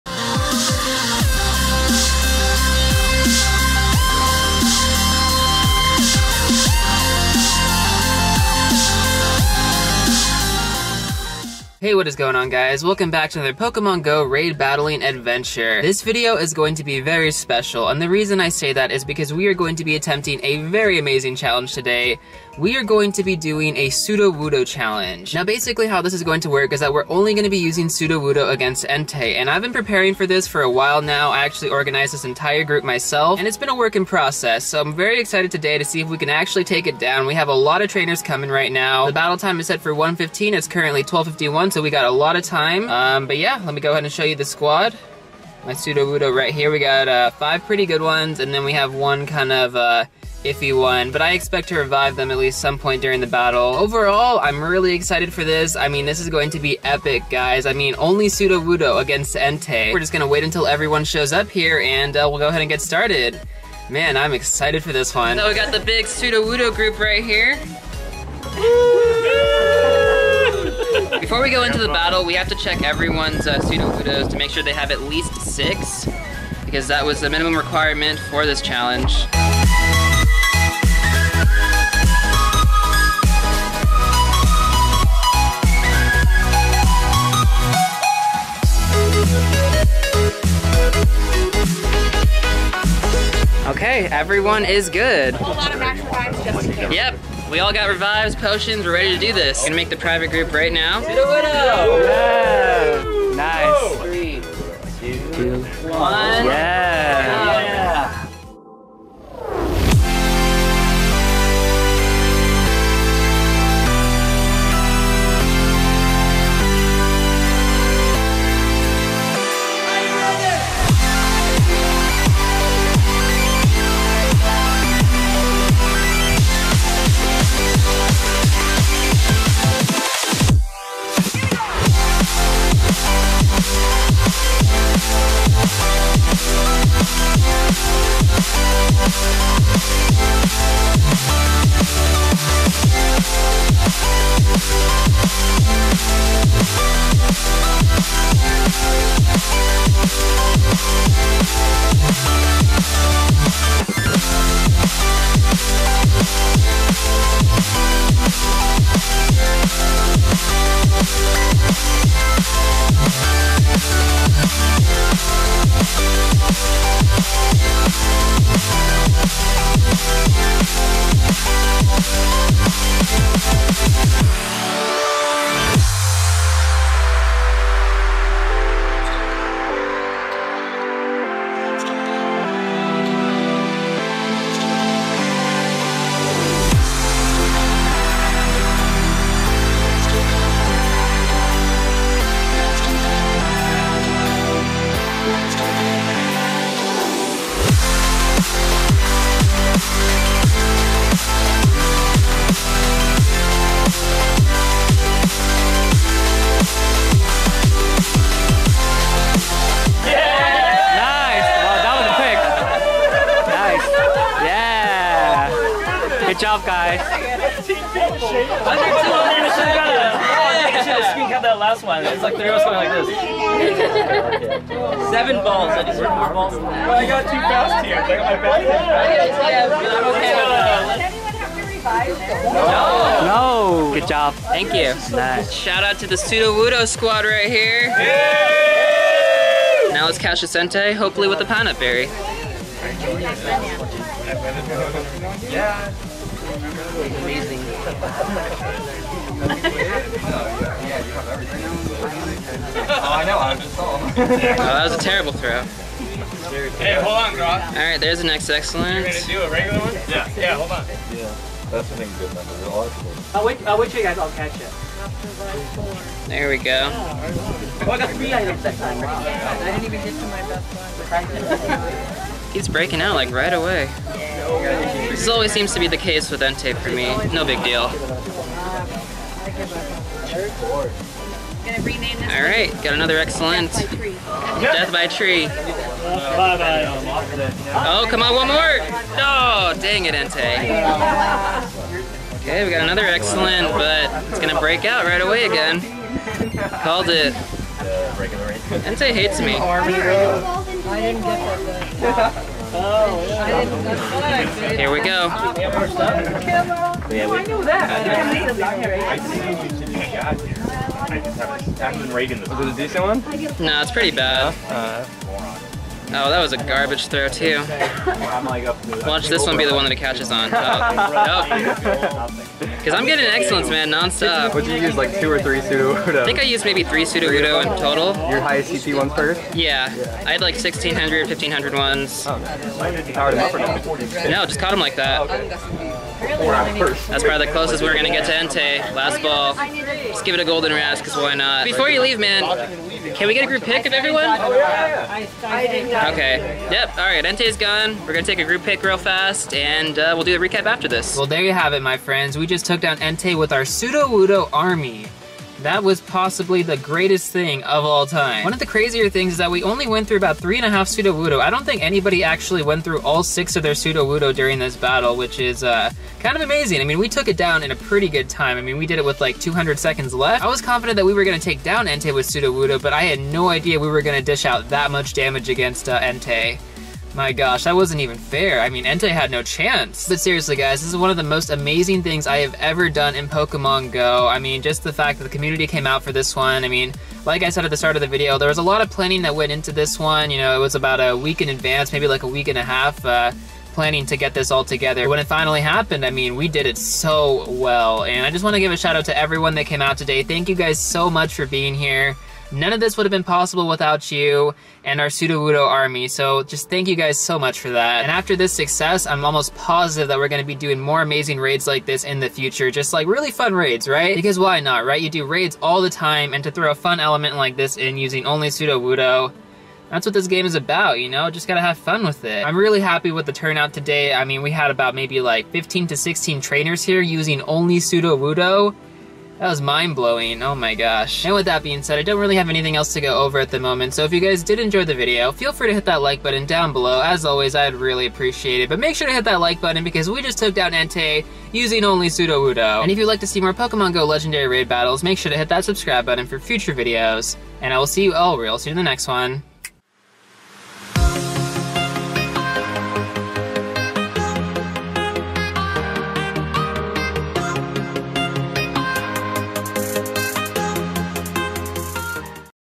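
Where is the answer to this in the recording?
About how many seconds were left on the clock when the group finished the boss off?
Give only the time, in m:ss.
6:09.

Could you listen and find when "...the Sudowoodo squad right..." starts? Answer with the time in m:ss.
3:56.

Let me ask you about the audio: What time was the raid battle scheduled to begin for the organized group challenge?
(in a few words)
1:15.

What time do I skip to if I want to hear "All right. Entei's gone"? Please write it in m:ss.
5:46.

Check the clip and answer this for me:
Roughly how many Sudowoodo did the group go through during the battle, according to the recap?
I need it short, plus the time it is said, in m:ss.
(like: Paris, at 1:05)
3.5, at 6:00.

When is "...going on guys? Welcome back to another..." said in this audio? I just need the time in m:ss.
0:12.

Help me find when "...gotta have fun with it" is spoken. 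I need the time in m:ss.
7:01.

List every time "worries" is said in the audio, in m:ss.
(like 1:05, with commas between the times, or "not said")
not said.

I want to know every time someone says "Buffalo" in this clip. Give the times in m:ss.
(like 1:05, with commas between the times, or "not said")
not said.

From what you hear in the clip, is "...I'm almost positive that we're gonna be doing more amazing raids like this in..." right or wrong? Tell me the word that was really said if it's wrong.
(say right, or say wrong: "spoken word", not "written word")
right.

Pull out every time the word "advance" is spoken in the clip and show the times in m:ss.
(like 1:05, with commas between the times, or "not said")
6:31.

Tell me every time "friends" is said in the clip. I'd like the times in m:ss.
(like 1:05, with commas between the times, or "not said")
5:51.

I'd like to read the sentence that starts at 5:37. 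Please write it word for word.
That's probably the closest we're going to get to Entei.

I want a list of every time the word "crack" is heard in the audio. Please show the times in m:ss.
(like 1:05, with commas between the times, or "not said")
not said.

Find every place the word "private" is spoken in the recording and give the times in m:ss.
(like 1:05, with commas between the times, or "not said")
1:39.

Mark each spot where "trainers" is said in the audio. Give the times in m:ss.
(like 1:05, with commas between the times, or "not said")
0:37, 7:06.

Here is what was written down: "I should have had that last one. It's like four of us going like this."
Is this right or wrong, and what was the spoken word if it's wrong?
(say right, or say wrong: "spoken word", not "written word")
wrong: "three", not "four".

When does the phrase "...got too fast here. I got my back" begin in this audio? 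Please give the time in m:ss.
3:47.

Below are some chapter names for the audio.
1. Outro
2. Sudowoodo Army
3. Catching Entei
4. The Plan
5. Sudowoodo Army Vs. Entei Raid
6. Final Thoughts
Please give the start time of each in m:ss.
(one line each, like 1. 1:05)
1. 7:12
2. 1:05
3. 3:51
4. 0:15
5. 1:41
6. 5:51.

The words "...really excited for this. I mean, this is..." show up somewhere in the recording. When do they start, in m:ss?
0:54.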